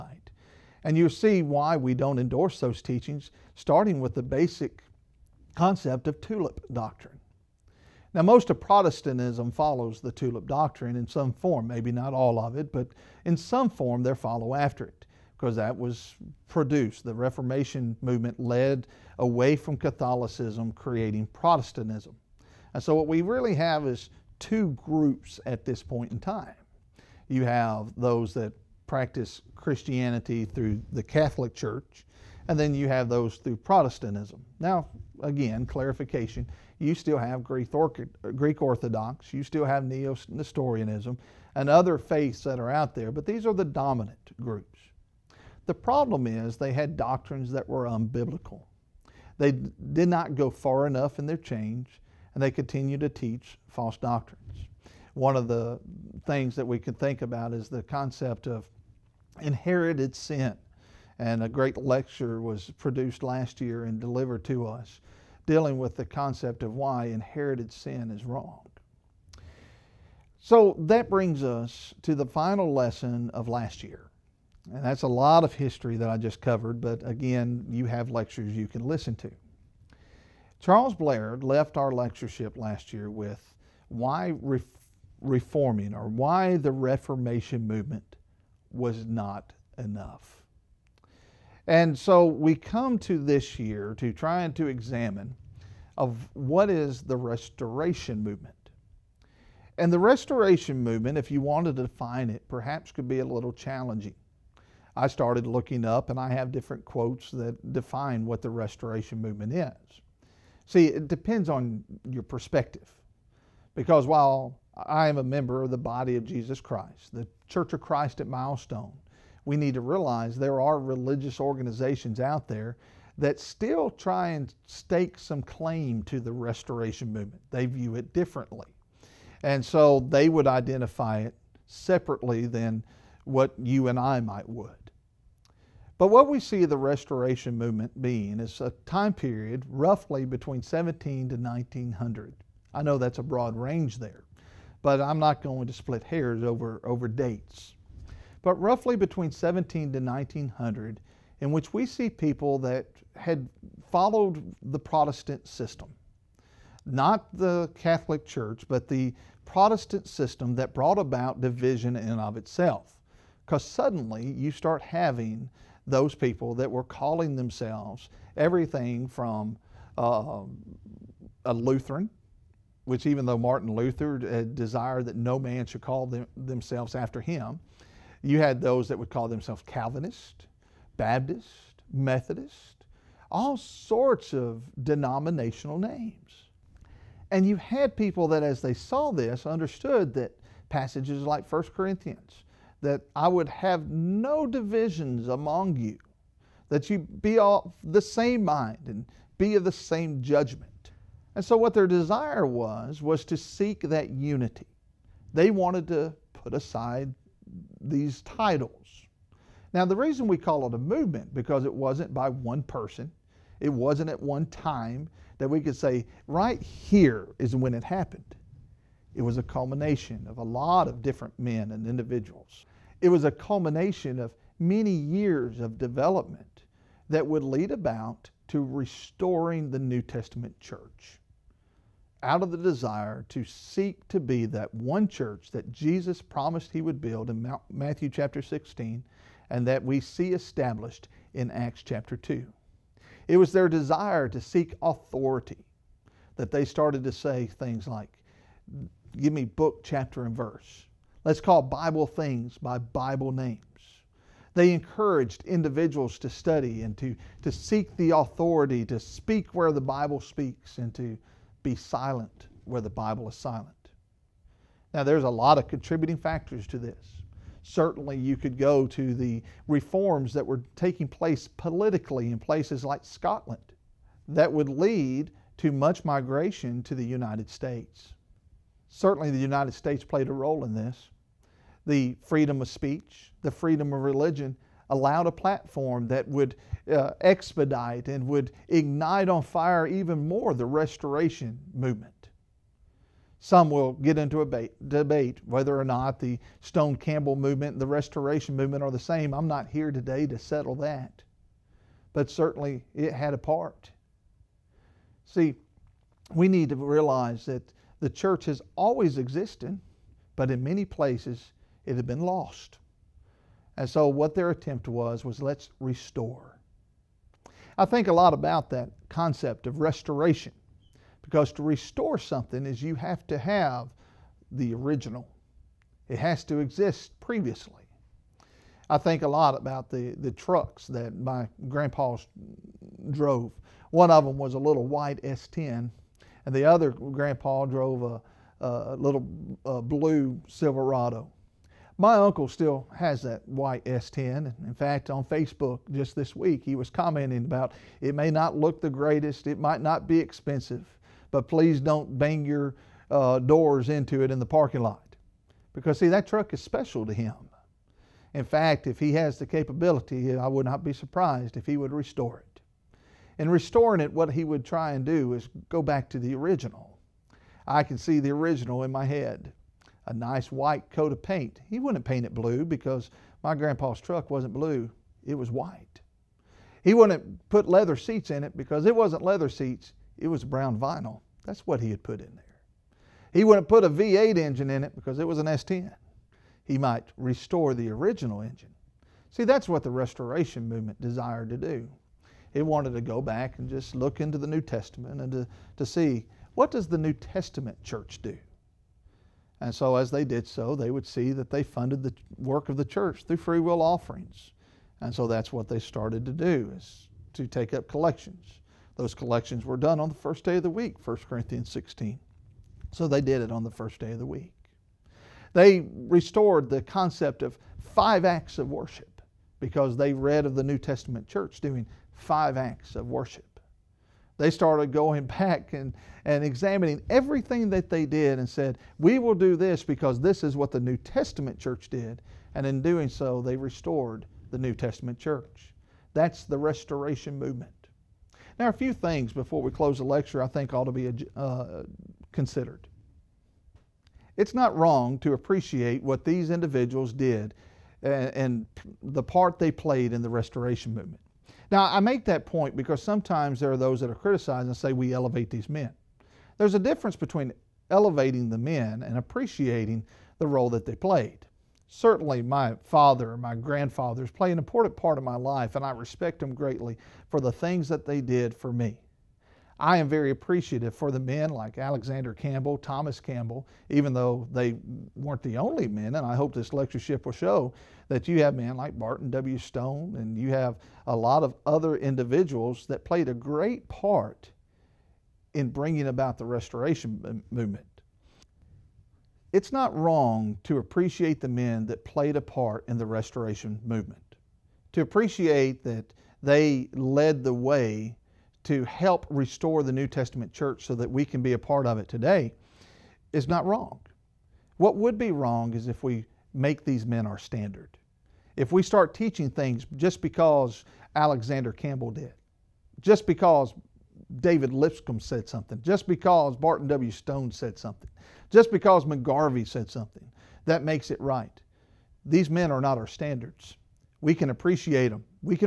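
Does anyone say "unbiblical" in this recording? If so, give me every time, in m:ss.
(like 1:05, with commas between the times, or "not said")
0:47.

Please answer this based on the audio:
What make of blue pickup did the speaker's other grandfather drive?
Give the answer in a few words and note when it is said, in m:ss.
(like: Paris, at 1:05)
Silverado, at 5:40.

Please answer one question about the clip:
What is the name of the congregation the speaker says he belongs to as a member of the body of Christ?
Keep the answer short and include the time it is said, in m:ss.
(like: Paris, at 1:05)
Church of Christ at Milestone, at 1:57.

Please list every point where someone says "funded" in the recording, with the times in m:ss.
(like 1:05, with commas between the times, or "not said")
6:41.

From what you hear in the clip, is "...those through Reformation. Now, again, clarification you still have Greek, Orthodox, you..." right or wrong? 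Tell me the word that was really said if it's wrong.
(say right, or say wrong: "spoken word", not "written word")
wrong: "Protestantism", not "Reformation".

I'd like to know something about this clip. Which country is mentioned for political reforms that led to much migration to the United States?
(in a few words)
Scotland.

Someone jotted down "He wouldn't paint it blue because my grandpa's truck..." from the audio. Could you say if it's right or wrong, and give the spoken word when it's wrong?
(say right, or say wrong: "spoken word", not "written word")
right.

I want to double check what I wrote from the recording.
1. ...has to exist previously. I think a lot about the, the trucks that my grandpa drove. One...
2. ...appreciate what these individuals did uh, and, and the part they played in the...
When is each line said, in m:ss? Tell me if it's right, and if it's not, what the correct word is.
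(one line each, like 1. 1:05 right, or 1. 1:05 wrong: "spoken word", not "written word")
1. 5:26 right
2. 7:25 right.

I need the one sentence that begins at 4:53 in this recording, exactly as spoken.
Some will get into a debate, debate whether or not the Stone Campbell movement and the restoration movement are the same.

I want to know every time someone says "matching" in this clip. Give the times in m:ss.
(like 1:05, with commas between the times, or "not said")
not said.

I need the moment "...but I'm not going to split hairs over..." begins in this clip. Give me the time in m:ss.
2:24.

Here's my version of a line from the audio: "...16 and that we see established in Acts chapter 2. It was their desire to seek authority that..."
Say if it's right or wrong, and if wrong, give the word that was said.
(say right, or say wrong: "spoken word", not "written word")
right.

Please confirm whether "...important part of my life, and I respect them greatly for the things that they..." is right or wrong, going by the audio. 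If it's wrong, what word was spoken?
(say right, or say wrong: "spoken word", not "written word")
right.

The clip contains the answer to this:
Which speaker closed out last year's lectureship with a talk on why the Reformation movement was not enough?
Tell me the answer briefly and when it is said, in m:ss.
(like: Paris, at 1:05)
Charles Blair, at 1:20.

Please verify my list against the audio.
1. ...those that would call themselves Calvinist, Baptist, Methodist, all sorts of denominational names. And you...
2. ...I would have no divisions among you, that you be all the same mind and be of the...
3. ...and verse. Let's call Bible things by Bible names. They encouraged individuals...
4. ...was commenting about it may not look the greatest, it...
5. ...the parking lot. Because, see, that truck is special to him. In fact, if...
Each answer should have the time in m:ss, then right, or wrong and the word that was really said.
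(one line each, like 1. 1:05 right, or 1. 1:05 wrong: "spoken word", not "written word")
1. 2:58 right
2. 3:13 right
3. 4:10 right
4. 5:46 right
5. 5:54 right.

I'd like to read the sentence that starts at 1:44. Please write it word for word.
I started looking up and I have different quotes that define what the restoration movement is.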